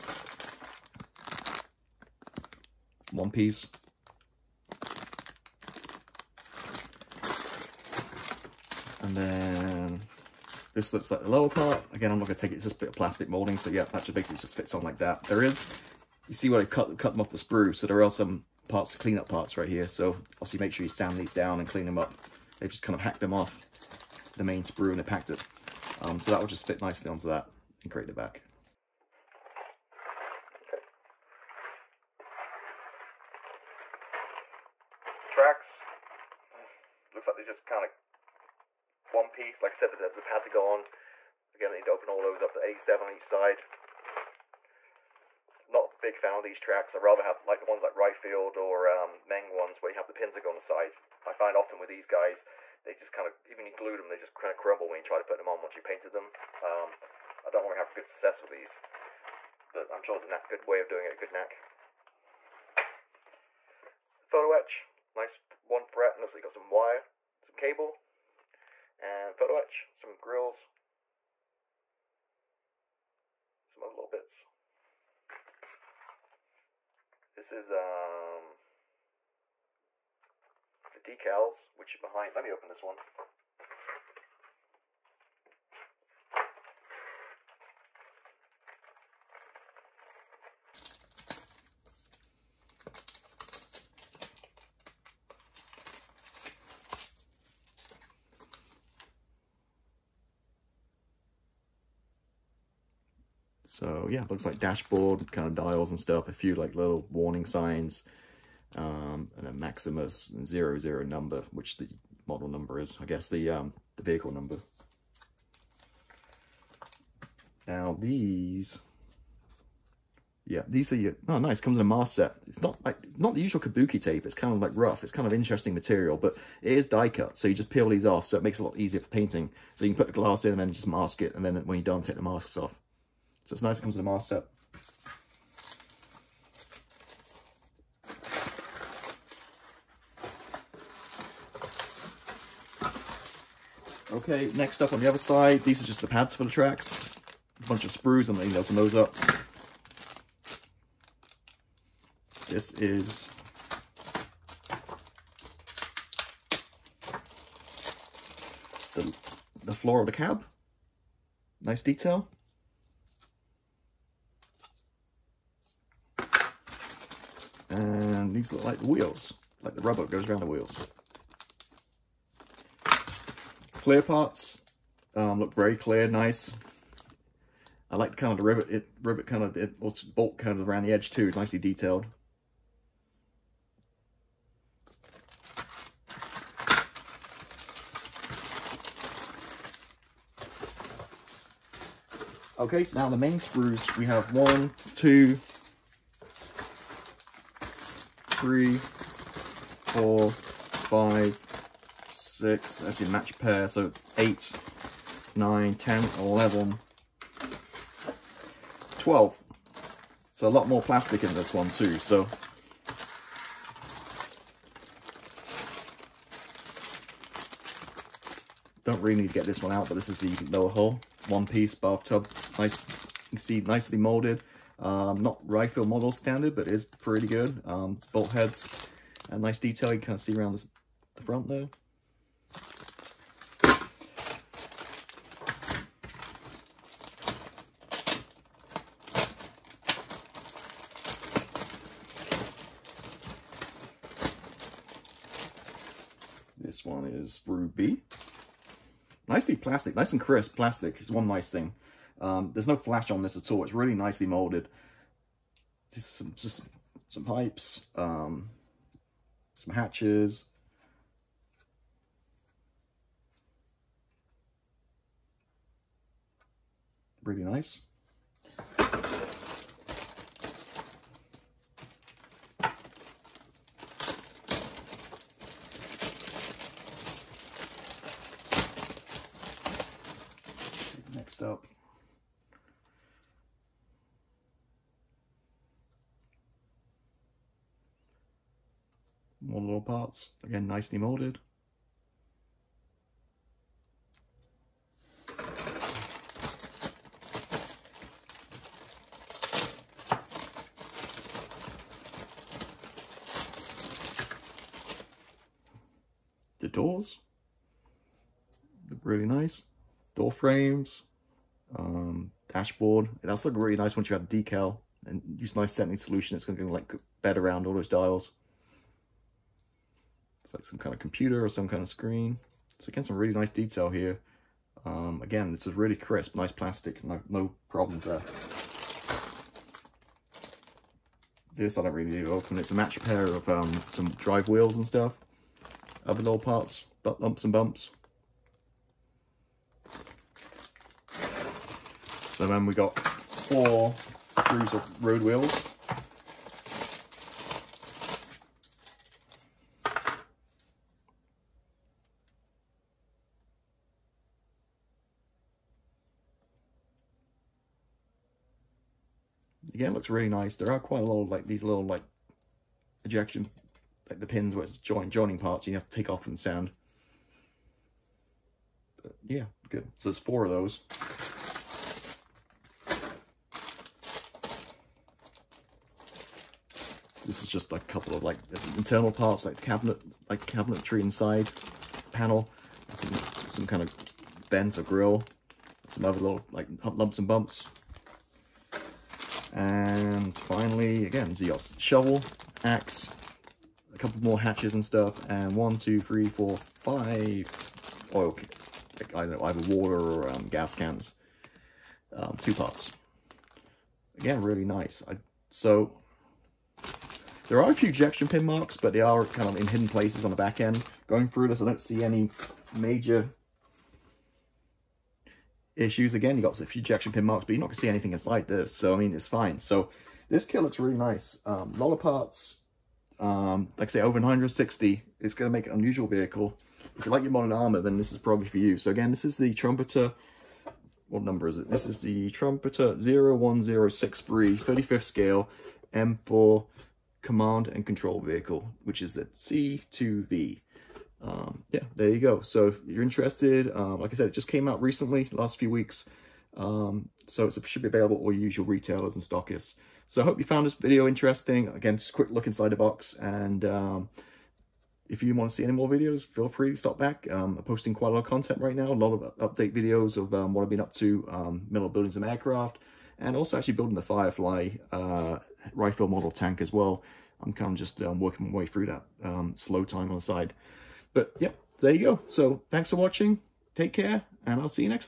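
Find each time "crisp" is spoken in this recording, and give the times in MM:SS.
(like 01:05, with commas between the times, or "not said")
04:10, 05:25.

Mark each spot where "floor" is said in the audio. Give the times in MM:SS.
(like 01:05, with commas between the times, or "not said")
02:39.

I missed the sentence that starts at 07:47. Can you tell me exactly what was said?
I'm kind of just um, working my way through that um, slow time on the side.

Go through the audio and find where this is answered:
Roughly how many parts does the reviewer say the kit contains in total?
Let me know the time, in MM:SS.
07:04.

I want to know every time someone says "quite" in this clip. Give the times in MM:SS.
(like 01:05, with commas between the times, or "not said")
06:00, 07:37.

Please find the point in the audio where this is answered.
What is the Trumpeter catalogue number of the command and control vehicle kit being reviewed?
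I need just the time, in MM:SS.
07:12.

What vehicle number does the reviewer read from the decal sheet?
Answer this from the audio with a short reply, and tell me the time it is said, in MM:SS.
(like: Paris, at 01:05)
Maximus 00, at 01:49.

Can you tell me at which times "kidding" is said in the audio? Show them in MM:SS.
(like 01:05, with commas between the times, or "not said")
not said.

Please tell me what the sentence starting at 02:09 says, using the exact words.
So you can put the glass in and then just mask it, and then when you're done, take the masks off.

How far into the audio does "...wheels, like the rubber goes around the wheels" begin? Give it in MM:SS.
02:48.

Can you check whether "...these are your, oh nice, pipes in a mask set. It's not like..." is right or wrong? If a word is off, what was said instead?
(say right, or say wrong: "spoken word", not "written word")
wrong: "comes", not "pipes".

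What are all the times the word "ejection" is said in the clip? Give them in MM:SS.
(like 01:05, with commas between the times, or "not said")
06:03, 06:47, 06:56.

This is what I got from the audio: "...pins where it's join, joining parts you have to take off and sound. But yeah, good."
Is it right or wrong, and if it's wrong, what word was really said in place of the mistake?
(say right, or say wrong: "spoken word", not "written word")
right.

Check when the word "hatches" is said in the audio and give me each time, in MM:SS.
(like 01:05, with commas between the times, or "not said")
04:19, 06:34.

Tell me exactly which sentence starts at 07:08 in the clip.
So, again, this is the Trumpeter.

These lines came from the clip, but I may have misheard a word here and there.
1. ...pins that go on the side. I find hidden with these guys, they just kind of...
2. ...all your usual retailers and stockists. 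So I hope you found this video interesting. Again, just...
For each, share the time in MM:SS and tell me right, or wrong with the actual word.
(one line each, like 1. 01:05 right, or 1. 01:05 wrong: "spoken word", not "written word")
1. 00:50 wrong: "often", not "hidden"
2. 07:28 right.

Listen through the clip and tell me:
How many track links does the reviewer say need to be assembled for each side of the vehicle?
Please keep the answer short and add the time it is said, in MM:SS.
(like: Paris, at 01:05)
87, at 00:42.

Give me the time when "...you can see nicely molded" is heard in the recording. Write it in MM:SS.
03:43.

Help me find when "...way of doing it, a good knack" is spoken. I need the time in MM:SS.
01:00.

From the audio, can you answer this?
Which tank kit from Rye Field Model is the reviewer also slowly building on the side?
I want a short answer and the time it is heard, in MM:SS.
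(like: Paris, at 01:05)
Firefly, at 07:44.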